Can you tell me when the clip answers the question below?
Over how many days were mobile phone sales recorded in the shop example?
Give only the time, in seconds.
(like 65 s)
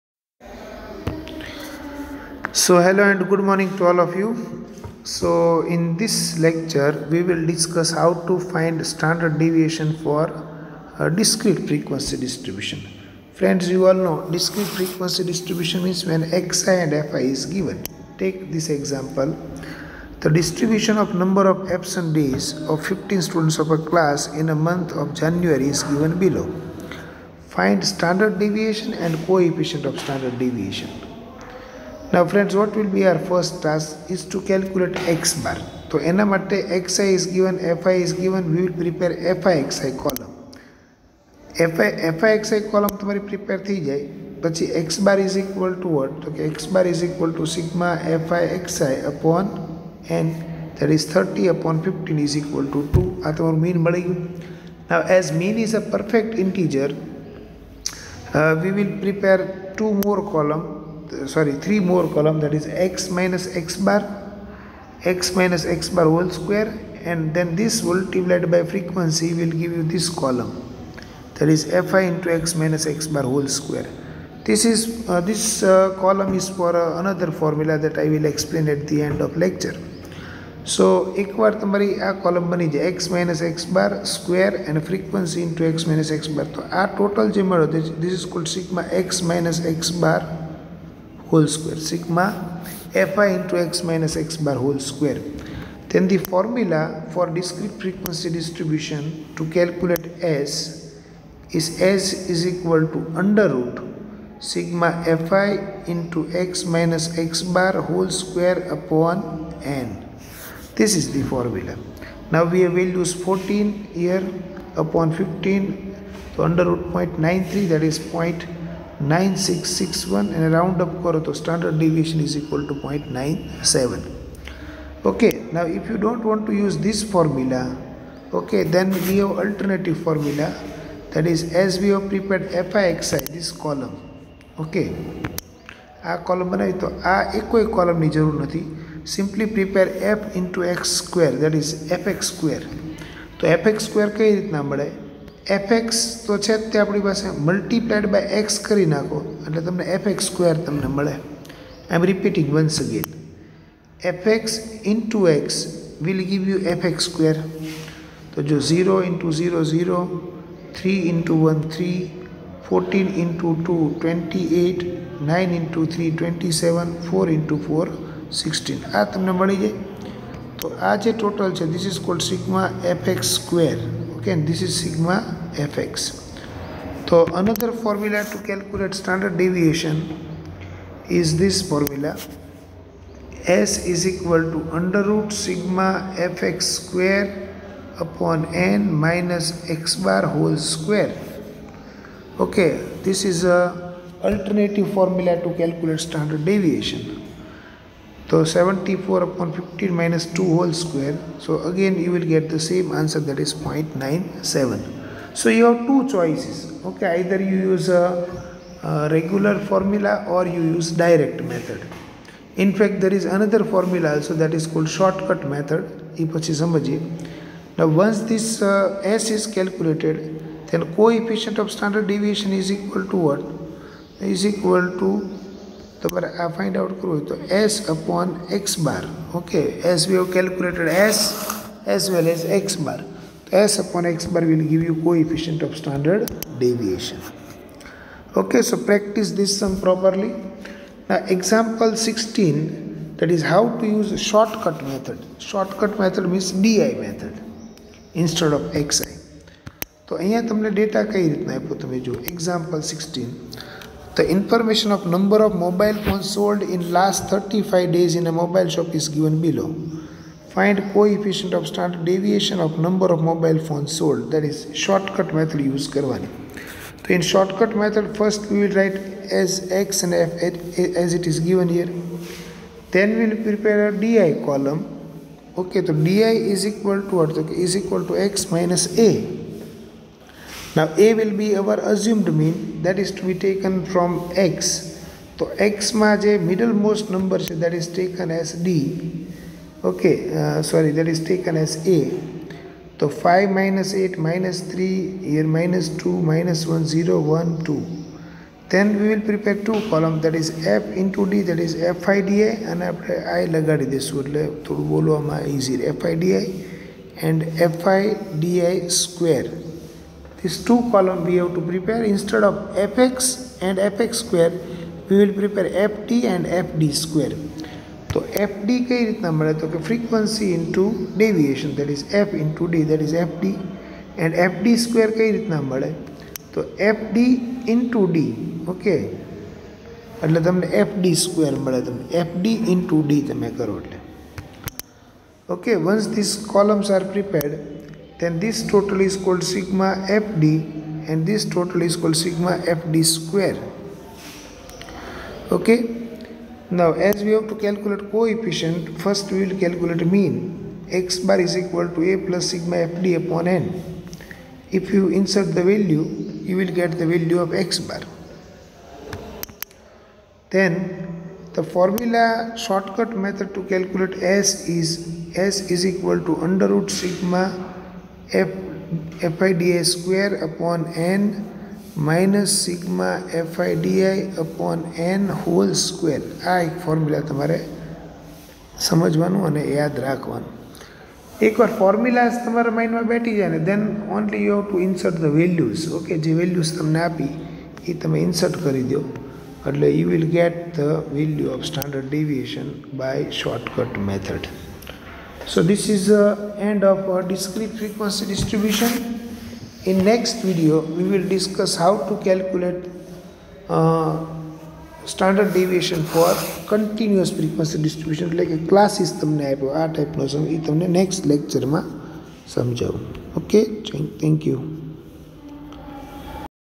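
257 s.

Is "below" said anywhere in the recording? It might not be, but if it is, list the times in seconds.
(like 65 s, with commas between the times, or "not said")
26 s, 259 s.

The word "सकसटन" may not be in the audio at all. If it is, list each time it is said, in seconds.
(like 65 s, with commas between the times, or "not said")
242 s, 252 s.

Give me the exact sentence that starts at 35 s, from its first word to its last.
So, enna matte xi is given, fi is given, we will prepare fi xi column.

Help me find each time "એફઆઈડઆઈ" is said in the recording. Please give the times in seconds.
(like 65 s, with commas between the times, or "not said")
369 s, 373 s.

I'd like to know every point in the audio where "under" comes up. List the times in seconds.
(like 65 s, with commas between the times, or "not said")
103 s, 116 s, 184 s, 366 s.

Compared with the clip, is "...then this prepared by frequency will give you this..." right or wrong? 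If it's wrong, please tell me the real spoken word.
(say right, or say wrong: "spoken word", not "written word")
wrong: "multiplied", not "prepared".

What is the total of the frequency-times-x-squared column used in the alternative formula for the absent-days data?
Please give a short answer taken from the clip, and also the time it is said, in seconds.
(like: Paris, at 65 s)
74, at 198 s.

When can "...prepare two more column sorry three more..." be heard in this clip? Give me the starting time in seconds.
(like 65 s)
58 s.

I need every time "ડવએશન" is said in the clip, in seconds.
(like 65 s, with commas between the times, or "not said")
321 s, 392 s.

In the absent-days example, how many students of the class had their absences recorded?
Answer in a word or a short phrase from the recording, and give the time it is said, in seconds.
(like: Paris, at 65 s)
15, at 22 s.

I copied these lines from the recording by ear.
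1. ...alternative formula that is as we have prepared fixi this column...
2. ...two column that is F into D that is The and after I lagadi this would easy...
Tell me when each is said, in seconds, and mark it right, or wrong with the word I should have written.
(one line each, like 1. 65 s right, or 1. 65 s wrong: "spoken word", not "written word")
1. 129 s right
2. 299 s wrong: "FIDA", not "The".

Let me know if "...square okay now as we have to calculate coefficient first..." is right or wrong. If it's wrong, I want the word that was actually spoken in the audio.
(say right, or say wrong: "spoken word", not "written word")
right.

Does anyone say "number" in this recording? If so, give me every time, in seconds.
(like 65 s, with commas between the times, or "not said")
21 s, 255 s, 262 s, 287 s.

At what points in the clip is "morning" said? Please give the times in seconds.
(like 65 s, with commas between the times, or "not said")
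3 s.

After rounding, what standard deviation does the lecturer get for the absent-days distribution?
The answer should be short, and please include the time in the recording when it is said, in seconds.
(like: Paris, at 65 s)
0.97, at 121 s.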